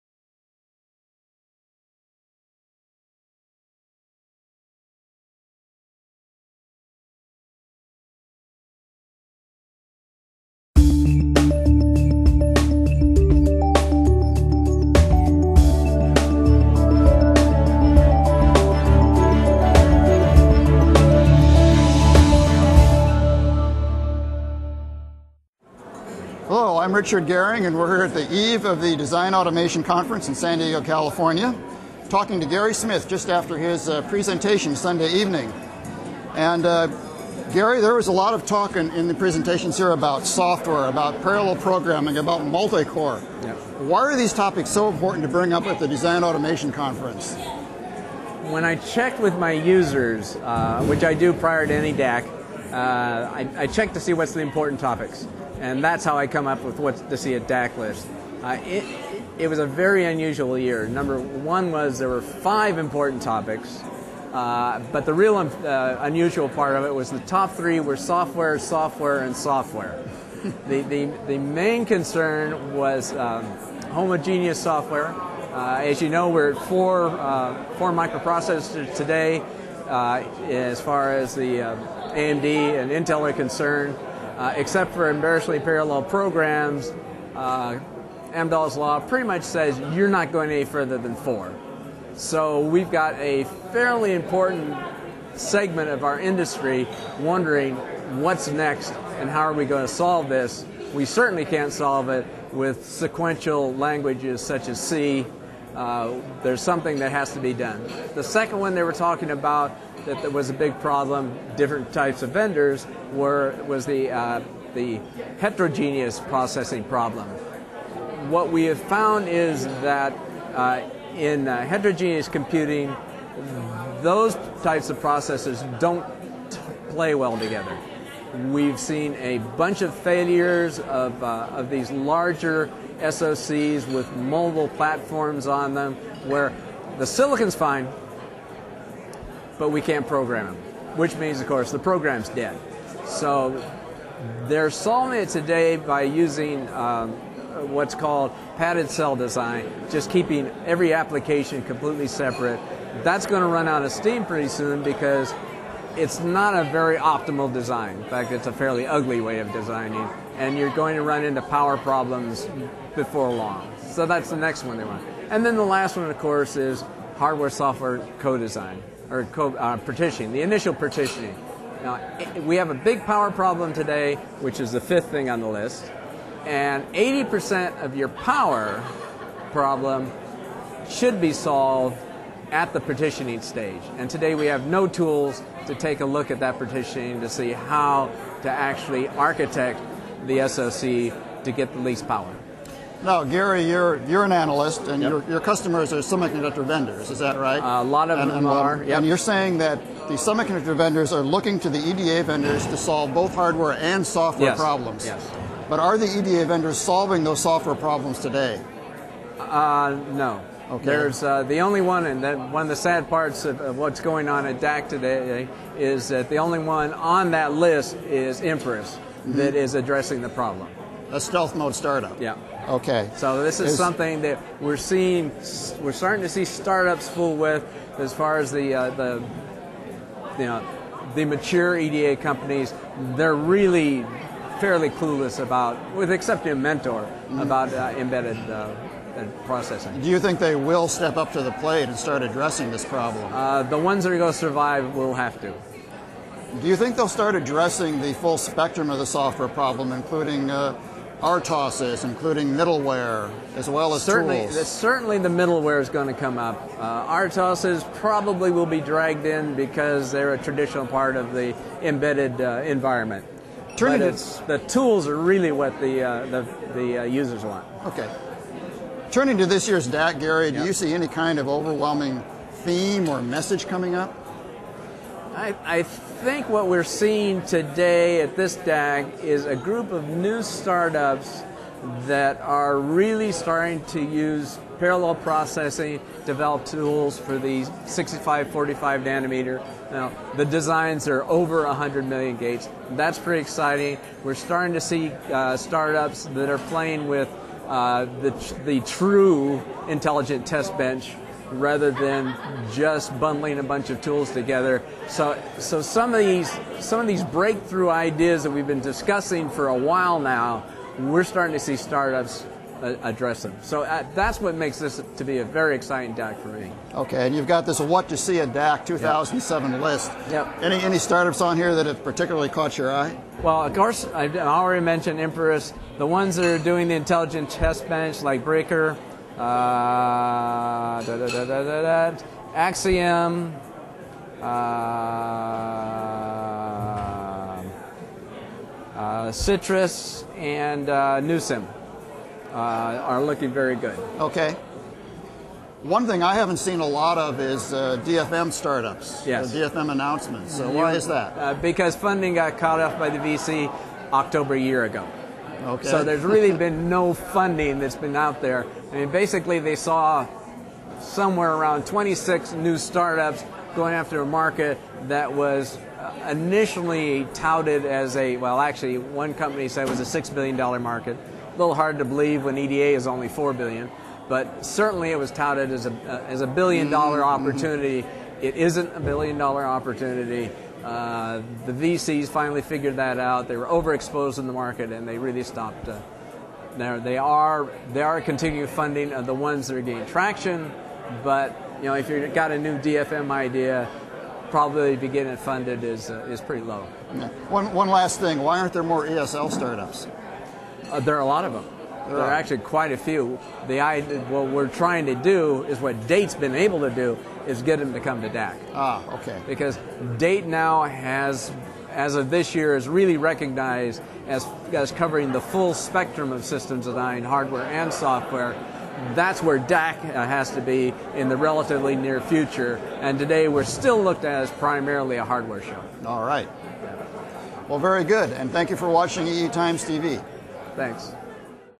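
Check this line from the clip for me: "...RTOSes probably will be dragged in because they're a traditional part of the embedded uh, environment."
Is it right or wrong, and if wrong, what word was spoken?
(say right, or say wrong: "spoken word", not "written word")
right.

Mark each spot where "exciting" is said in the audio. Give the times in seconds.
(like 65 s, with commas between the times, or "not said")
293 s, 315 s.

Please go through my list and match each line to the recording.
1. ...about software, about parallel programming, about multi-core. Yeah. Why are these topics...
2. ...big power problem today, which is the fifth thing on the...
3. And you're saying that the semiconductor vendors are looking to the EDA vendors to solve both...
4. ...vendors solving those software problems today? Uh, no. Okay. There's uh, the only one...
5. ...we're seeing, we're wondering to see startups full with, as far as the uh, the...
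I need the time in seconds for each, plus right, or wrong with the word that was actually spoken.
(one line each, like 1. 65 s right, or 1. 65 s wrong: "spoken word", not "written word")
1. 39 s right
2. 172 s right
3. 198 s right
4. 206 s right
5. 224 s wrong: "starting", not "wondering".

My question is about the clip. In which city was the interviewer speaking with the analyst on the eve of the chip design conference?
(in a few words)
San Diego.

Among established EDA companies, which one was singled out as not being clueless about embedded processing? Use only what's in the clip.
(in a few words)
Mentor.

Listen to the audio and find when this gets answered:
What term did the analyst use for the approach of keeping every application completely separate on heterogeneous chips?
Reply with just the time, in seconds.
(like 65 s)
148 s.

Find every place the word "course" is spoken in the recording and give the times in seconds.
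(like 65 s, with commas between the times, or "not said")
141 s, 166 s, 323 s.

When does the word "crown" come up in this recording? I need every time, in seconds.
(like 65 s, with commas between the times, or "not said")
not said.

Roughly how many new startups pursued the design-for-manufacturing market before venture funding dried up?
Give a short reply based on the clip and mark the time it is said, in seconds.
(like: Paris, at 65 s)
26, at 361 s.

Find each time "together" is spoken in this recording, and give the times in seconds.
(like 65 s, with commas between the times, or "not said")
127 s, 304 s.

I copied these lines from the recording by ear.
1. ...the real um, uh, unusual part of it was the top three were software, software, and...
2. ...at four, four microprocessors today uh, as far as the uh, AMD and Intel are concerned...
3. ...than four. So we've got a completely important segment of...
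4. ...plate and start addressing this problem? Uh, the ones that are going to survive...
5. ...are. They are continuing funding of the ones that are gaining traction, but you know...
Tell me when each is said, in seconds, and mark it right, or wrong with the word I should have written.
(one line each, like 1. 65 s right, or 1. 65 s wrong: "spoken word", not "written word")
1. 65 s right
2. 76 s right
3. 90 s wrong: "fairly", not "completely"
4. 241 s right
5. 387 s right.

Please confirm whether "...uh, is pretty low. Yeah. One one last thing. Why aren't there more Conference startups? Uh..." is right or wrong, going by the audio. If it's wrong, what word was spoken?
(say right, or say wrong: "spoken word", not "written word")
wrong: "ESL", not "Conference".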